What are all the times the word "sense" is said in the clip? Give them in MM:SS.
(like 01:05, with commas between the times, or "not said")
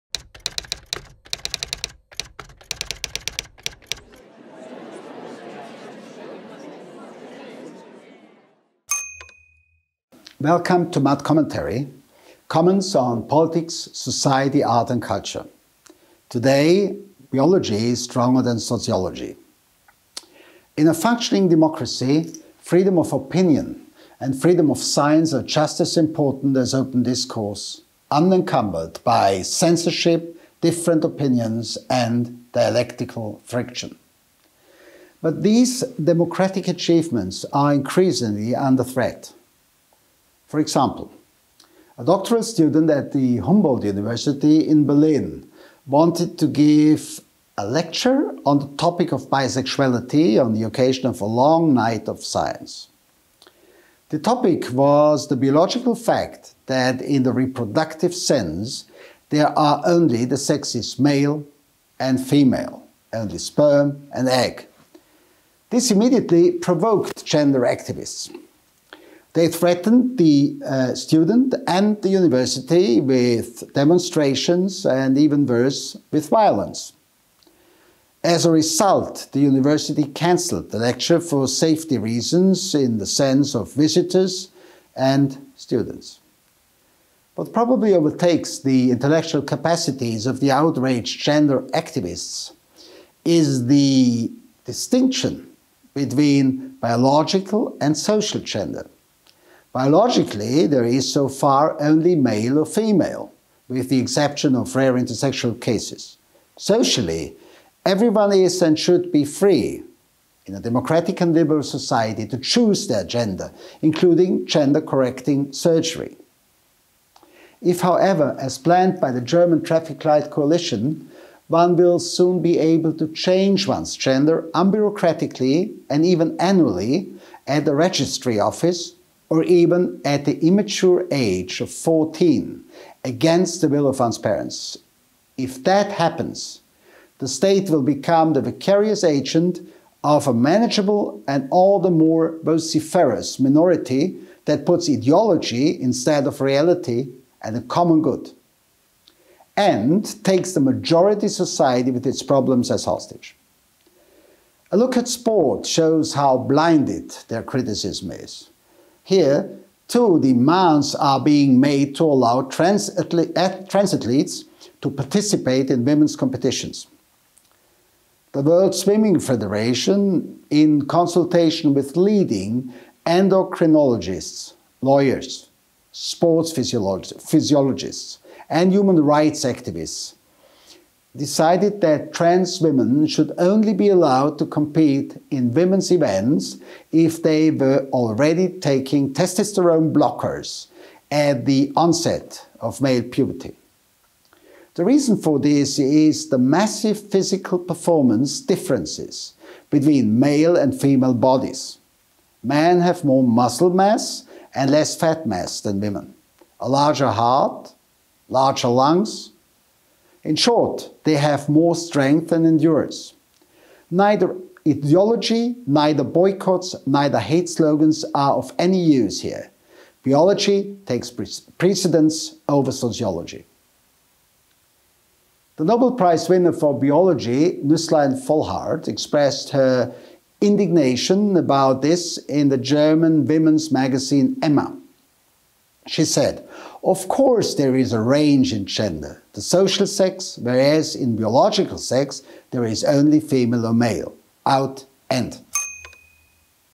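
00:58, 01:23.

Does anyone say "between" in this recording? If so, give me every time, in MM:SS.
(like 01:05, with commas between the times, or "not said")
01:35, 03:19.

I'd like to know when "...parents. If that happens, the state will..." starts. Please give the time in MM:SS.
02:14.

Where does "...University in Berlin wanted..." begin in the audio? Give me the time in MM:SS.
00:43.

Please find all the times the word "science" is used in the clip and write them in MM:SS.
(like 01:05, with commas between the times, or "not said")
00:24, 00:52.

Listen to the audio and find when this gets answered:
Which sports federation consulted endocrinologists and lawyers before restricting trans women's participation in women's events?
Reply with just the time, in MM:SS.
02:48.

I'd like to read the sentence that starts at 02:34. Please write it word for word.
A look at sport shows how blinded their criticism is.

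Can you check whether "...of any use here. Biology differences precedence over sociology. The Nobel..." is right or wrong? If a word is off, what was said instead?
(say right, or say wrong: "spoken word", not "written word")
wrong: "takes", not "differences".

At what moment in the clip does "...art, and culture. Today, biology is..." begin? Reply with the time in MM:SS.
00:14.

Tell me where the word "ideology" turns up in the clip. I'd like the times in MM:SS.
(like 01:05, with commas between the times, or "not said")
02:24, 03:34.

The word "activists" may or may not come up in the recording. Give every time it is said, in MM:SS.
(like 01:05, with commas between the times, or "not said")
01:07, 01:31, 02:59.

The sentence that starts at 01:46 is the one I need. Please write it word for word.
Socially, everyone is and should be free in a democratic and liberal society to choose their gender, including gender correcting surgery.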